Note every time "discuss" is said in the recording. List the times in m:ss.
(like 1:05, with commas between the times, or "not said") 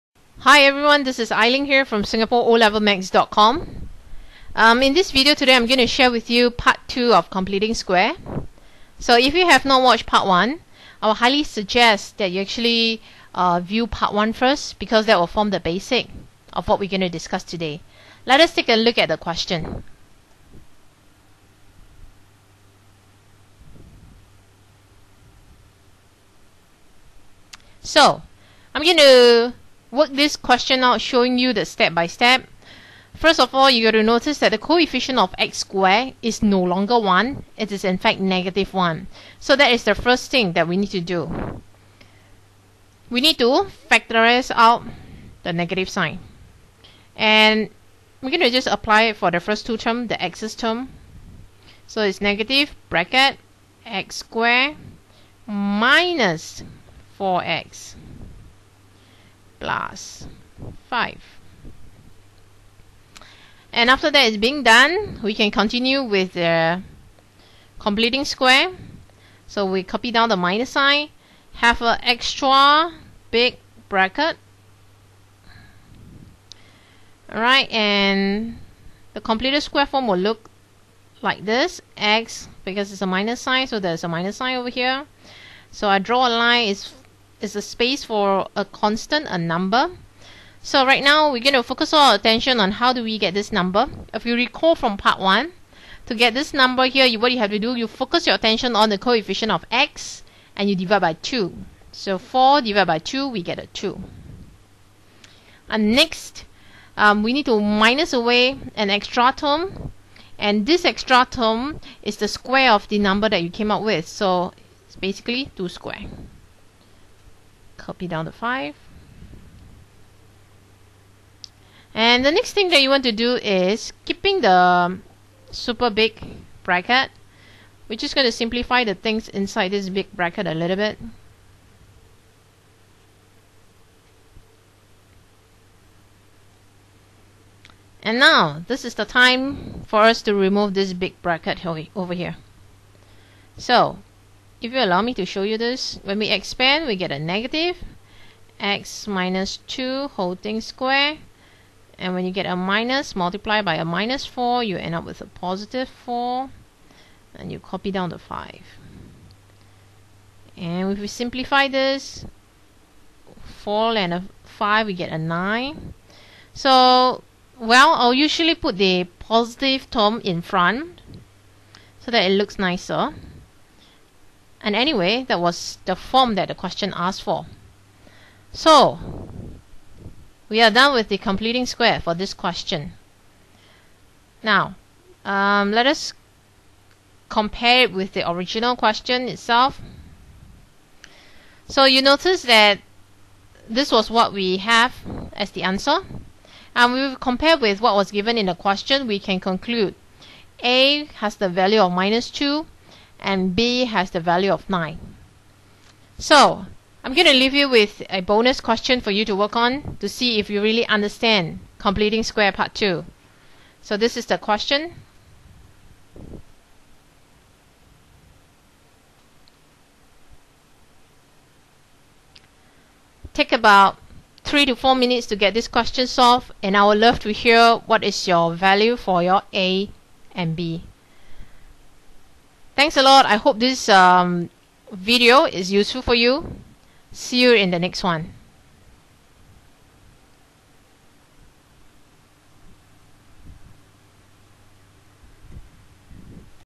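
0:17.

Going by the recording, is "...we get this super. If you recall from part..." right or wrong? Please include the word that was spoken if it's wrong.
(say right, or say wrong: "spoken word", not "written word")
wrong: "number", not "super".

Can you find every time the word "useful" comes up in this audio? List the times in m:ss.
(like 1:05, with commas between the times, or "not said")
3:55.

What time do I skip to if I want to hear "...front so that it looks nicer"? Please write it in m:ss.
2:50.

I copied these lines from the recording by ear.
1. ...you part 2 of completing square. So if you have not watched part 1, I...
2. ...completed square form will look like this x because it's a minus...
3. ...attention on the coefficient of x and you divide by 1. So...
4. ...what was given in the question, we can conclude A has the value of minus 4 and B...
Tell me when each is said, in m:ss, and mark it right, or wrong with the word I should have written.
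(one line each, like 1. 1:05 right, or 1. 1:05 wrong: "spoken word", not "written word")
1. 0:06 right
2. 1:19 right
3. 1:38 wrong: "2", not "1"
4. 3:17 wrong: "2", not "4".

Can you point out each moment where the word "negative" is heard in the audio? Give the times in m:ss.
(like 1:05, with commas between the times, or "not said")
0:38, 0:45, 0:52, 2:27.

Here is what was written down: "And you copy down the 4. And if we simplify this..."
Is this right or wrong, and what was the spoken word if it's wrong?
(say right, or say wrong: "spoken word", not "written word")
wrong: "5", not "4".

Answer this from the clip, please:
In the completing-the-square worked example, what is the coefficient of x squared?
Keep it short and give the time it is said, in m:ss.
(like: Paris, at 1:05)
-1, at 0:38.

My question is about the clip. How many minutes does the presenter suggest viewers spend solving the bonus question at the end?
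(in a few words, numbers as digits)
3 to 4 minutes.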